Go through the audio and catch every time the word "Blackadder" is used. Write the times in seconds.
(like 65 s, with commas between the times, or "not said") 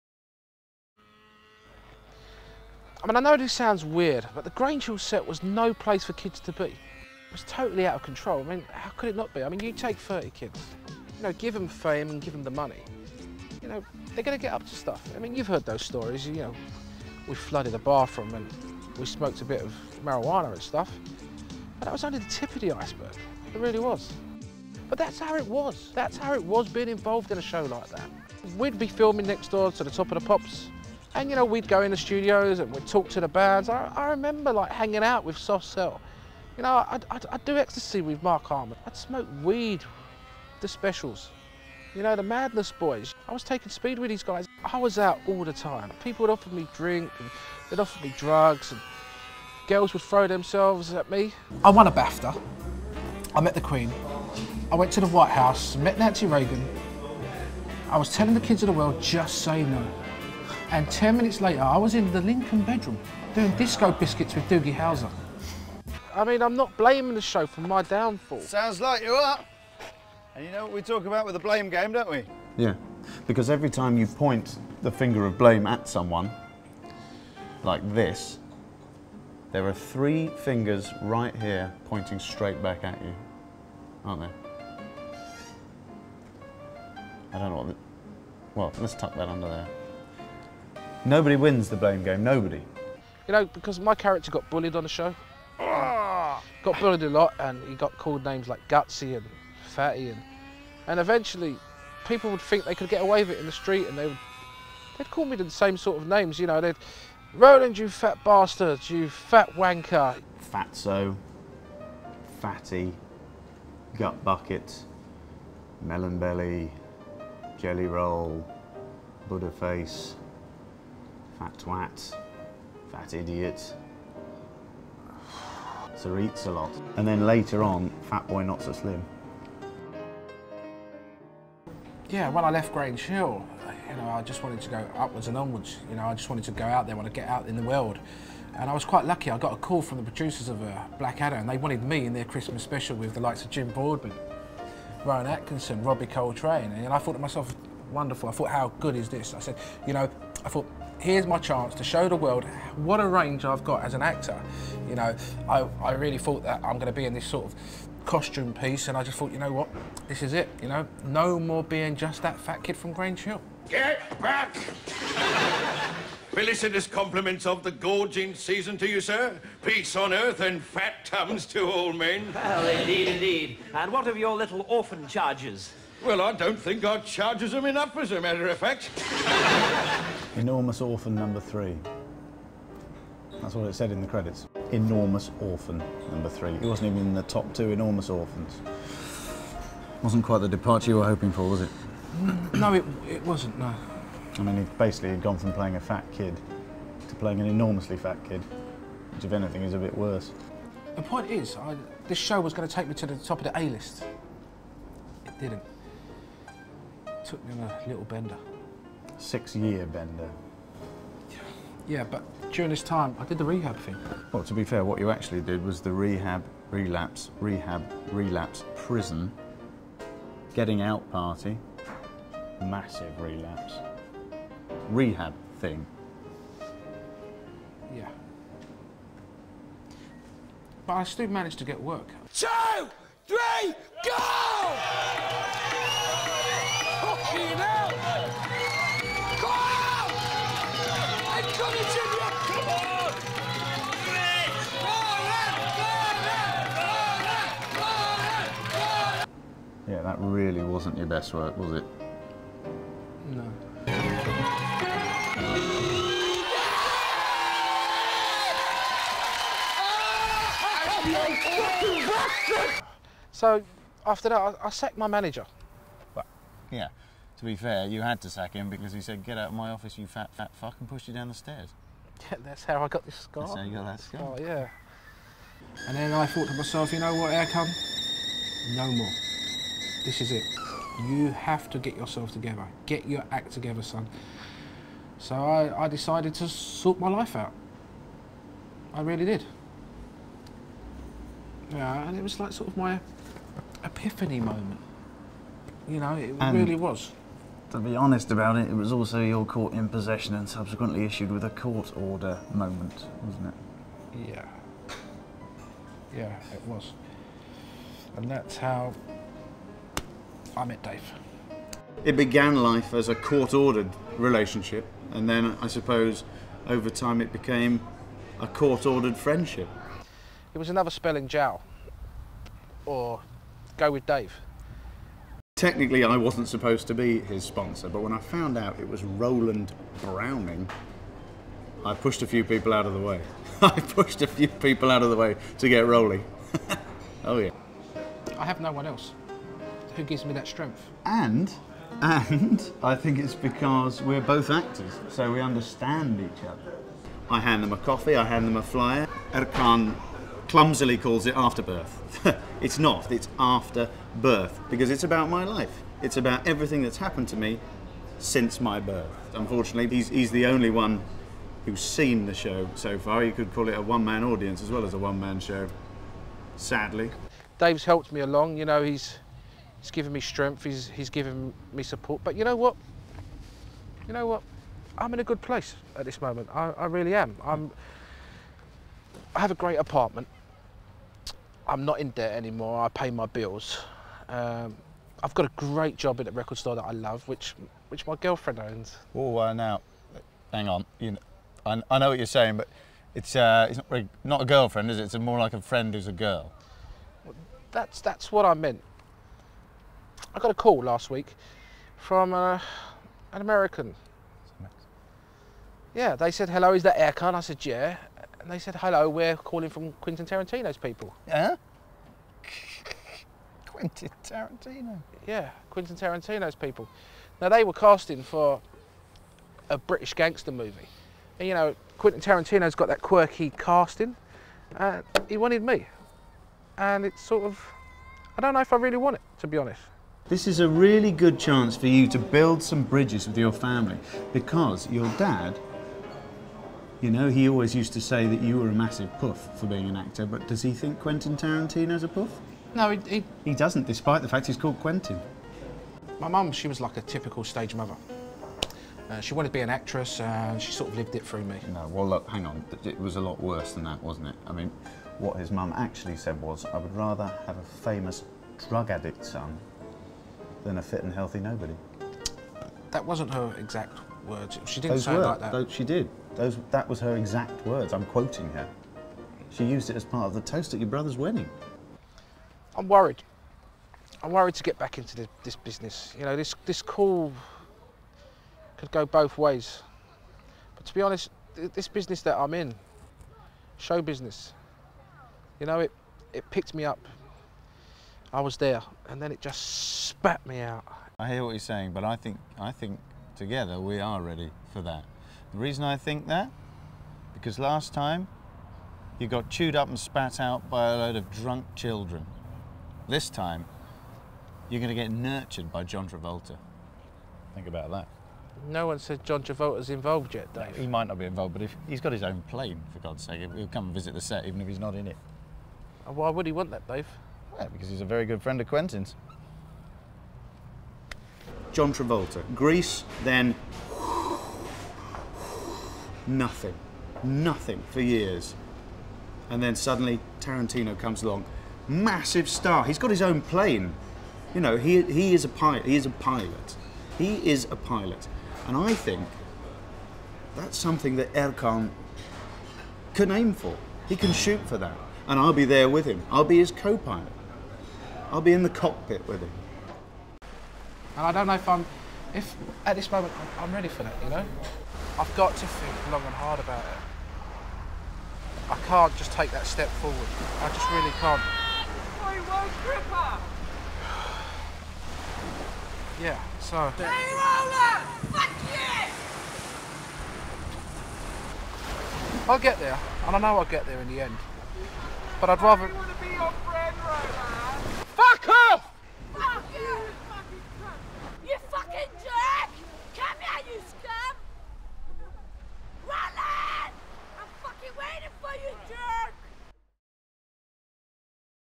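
140 s.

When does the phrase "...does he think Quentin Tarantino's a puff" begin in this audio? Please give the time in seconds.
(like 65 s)
440 s.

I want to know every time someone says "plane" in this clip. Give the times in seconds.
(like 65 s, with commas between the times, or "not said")
512 s, 533 s.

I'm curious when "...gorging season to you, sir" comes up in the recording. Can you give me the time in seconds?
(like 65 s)
167 s.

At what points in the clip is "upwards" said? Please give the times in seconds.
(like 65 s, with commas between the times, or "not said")
134 s.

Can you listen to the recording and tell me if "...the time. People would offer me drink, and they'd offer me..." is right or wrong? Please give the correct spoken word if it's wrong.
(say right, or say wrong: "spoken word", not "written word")
right.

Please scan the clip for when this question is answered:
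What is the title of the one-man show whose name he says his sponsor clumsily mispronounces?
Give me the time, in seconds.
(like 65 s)
353 s.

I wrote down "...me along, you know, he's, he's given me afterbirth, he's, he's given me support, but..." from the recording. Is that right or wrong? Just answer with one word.
wrong.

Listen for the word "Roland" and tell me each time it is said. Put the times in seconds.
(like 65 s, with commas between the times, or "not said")
107 s, 329 s.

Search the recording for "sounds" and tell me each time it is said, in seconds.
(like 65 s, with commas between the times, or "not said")
3 s, 68 s, 465 s.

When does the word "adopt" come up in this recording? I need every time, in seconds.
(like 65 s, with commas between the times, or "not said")
not said.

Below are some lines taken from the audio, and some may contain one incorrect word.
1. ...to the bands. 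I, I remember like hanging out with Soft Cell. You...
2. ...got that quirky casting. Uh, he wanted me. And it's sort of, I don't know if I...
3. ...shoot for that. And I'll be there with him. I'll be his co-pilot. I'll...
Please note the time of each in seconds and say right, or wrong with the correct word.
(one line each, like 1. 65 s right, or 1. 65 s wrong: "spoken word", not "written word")
1. 33 s right
2. 422 s right
3. 544 s right.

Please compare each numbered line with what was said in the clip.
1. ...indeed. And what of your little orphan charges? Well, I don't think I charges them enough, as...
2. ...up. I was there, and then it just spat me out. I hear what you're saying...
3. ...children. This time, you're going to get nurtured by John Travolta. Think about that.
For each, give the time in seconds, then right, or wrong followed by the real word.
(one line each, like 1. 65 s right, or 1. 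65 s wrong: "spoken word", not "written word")
1. 173 s right
2. 486 s right
3. 501 s right.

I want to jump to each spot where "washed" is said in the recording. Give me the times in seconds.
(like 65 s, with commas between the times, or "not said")
not said.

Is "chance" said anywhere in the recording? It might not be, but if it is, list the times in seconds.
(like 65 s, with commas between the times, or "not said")
151 s, 431 s.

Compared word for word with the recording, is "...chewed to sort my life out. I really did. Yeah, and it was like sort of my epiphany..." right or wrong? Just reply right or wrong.
wrong.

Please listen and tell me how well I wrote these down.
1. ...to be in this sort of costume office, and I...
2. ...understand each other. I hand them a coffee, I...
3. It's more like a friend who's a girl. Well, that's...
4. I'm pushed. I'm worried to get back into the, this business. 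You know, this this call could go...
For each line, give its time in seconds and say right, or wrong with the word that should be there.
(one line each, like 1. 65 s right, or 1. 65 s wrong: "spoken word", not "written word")
1. 156 s wrong: "piece", not "office"
2. 345 s right
3. 395 s right
4. 472 s wrong: "worried", not "pushed".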